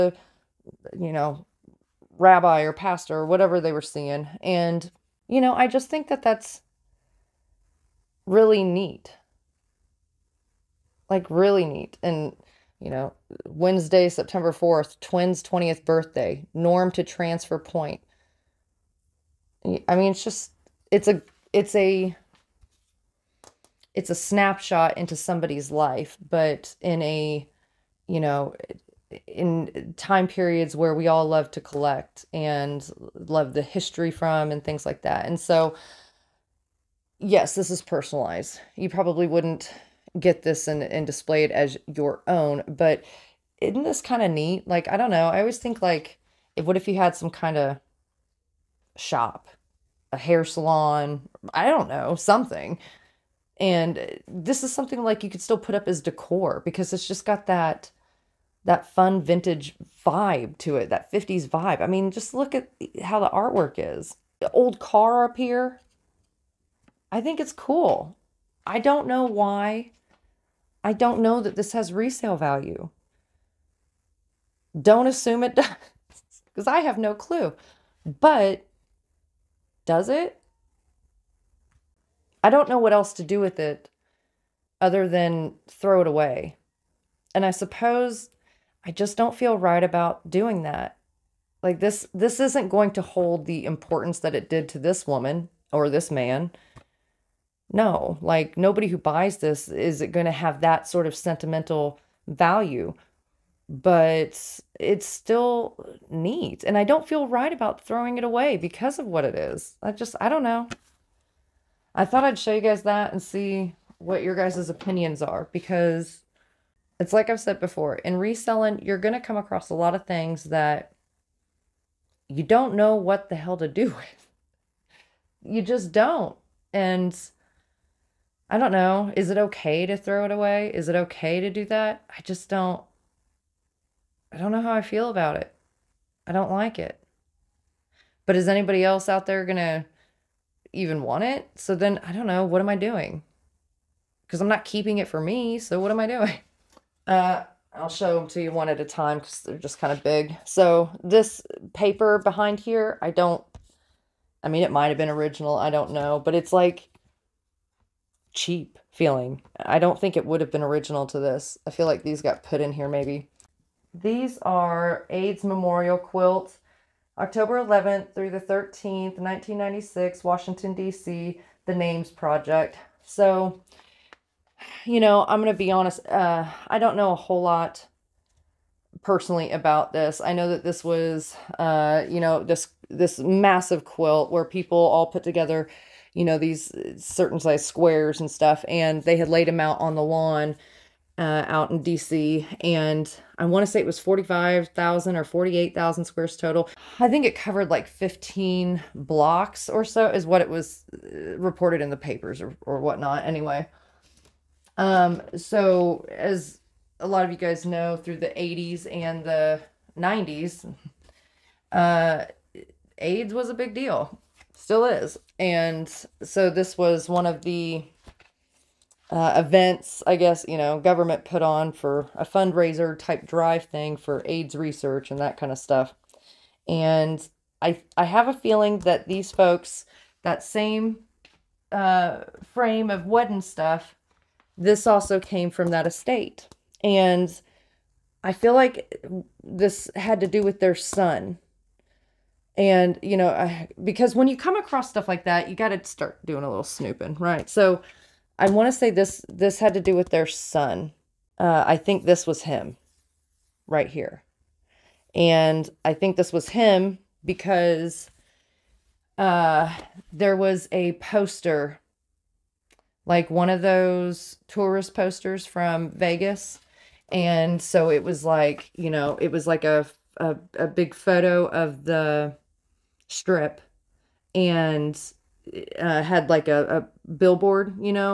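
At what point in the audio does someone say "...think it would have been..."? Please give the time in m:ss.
2:39.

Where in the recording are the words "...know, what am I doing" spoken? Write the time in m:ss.
2:22.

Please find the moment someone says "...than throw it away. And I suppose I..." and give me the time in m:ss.
1:25.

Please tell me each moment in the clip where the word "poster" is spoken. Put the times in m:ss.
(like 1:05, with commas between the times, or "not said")
4:20, 4:24.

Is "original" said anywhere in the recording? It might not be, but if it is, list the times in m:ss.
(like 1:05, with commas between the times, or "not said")
2:35, 2:40.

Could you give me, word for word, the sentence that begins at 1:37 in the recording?
No, like nobody who buys this is it going to have that sort of sentimental value.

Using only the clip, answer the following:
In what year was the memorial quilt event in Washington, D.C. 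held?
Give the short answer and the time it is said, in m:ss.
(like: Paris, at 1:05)
1996, at 2:49.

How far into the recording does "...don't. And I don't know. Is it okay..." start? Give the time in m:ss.
2:05.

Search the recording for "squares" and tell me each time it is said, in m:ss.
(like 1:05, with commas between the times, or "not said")
3:07, 3:16.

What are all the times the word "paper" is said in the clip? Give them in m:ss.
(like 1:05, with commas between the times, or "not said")
2:31, 3:21.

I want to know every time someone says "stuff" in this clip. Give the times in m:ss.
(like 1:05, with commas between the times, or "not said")
3:08, 3:45, 3:53, 4:04.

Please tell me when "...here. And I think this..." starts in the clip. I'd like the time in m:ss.
4:13.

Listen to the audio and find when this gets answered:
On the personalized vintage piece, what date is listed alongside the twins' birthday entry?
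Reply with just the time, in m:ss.
0:13.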